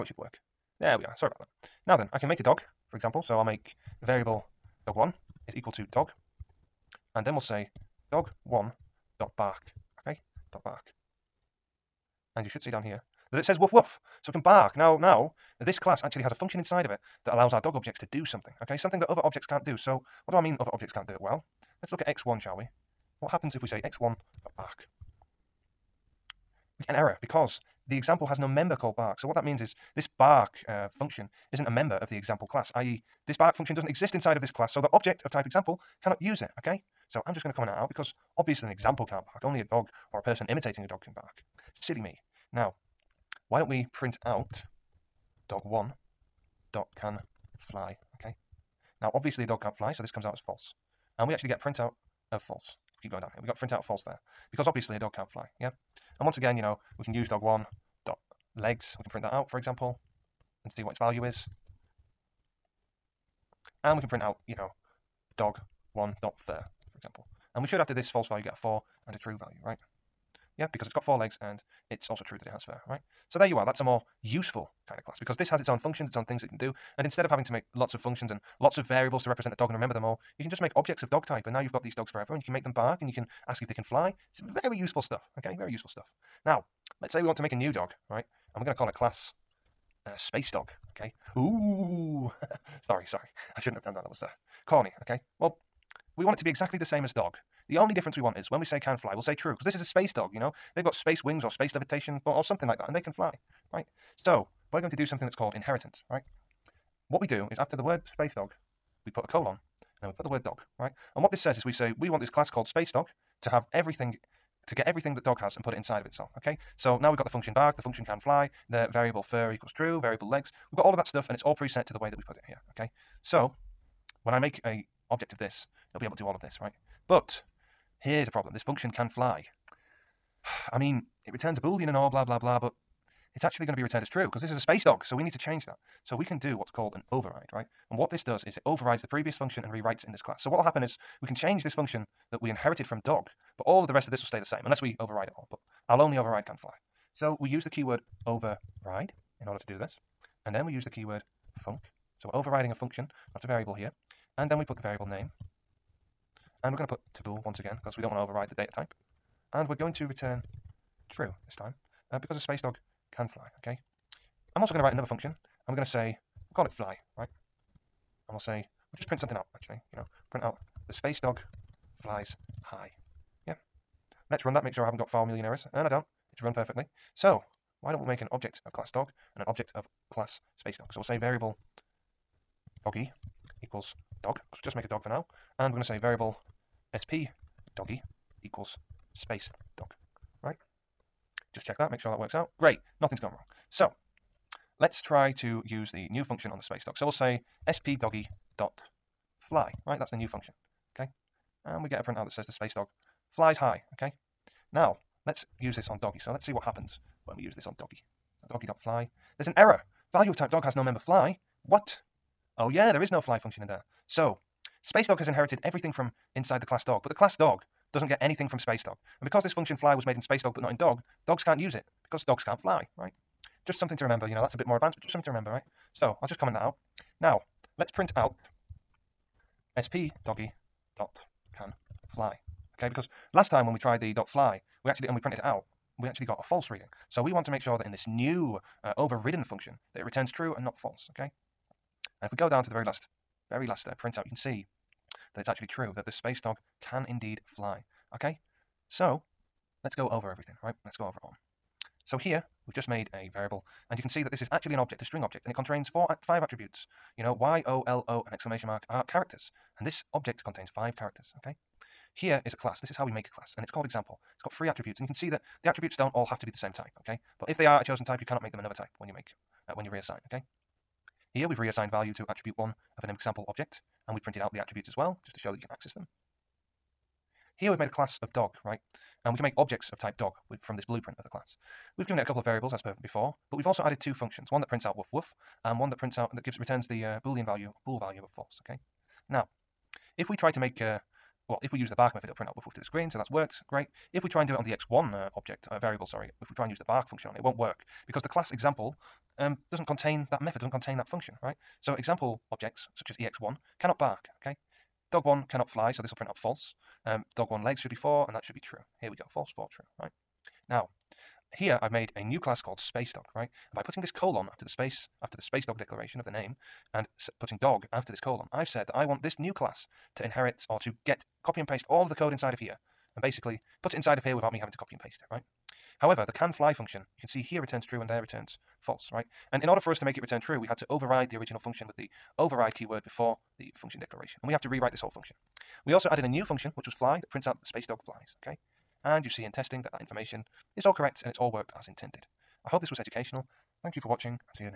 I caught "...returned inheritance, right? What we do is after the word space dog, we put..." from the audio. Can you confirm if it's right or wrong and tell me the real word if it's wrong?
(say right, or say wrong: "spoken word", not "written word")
wrong: "called", not "returned".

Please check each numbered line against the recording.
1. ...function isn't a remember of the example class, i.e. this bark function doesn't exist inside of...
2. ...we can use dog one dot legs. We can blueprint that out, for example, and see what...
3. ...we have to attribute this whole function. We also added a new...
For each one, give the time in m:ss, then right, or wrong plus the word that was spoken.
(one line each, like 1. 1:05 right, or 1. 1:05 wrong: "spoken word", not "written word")
1. 0:30 wrong: "member", not "remember"
2. 0:56 wrong: "print", not "blueprint"
3. 5:34 wrong: "rewrite", not "attribute".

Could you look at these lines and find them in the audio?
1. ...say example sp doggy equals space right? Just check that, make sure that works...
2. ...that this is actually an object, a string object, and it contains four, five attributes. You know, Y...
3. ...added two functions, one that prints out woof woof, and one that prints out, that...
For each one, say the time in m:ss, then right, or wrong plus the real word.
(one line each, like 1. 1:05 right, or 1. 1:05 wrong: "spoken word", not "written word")
1. 3:05 wrong: "variable", not "example"
2. 4:14 right
3. 4:43 right.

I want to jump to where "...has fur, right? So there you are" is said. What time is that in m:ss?
1:12.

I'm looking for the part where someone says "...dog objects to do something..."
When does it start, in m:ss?
0:17.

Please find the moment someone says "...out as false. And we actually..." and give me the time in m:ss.
0:50.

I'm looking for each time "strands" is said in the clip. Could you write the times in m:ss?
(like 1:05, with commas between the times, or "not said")
not said.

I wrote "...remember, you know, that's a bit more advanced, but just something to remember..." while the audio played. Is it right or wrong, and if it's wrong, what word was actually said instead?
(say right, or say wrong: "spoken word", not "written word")
right.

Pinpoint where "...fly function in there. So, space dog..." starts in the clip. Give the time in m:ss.
3:33.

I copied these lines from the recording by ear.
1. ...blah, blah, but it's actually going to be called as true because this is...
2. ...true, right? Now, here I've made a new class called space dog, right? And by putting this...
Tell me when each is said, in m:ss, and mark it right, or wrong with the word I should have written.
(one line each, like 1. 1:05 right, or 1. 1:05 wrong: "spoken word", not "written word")
1. 2:12 wrong: "returned", not "called"
2. 5:09 right.